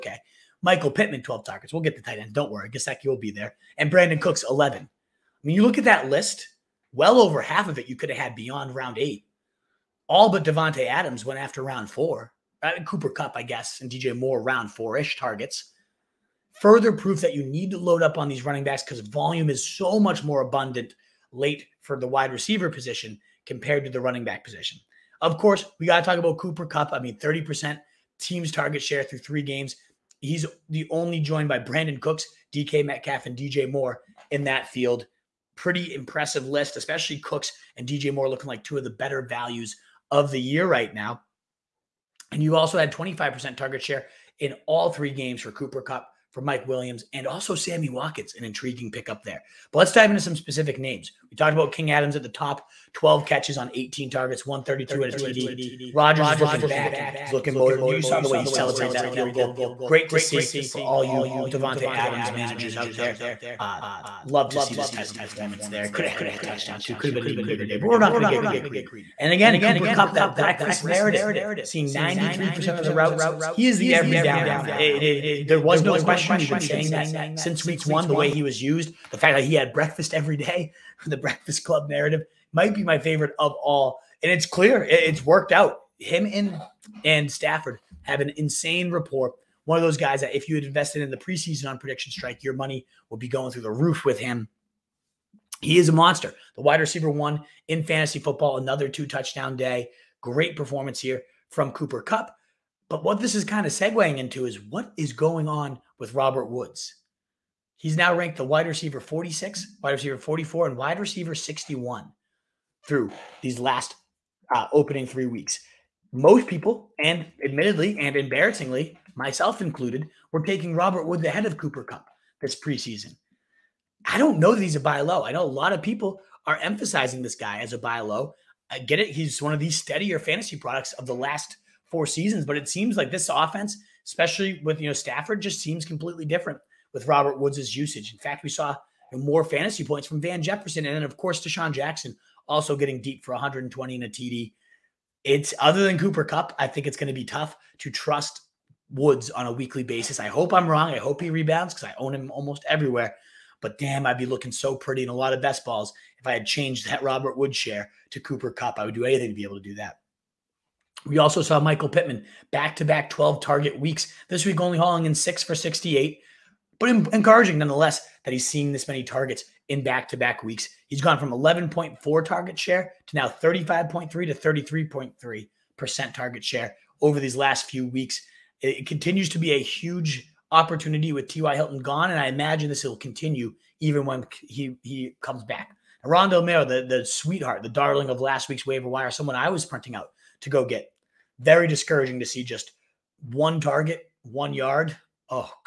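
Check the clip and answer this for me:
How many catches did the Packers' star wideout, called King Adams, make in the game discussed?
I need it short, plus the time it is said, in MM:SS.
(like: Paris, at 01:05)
12, at 00:52.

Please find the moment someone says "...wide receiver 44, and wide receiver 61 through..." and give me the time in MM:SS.
01:49.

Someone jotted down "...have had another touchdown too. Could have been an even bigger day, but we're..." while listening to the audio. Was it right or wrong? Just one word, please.
right.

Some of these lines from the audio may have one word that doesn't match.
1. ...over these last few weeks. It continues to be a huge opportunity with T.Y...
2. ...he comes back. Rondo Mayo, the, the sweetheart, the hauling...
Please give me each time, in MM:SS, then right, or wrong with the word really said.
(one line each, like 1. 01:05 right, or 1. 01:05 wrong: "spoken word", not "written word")
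1. 02:56 right
2. 03:04 wrong: "darling", not "hauling".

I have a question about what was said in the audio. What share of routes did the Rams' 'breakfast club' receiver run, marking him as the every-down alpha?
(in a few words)
93%.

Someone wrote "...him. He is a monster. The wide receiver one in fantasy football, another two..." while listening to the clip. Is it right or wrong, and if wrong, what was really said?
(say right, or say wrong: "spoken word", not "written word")
right.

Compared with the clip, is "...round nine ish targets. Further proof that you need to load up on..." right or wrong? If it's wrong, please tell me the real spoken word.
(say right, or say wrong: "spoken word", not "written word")
wrong: "four", not "nine".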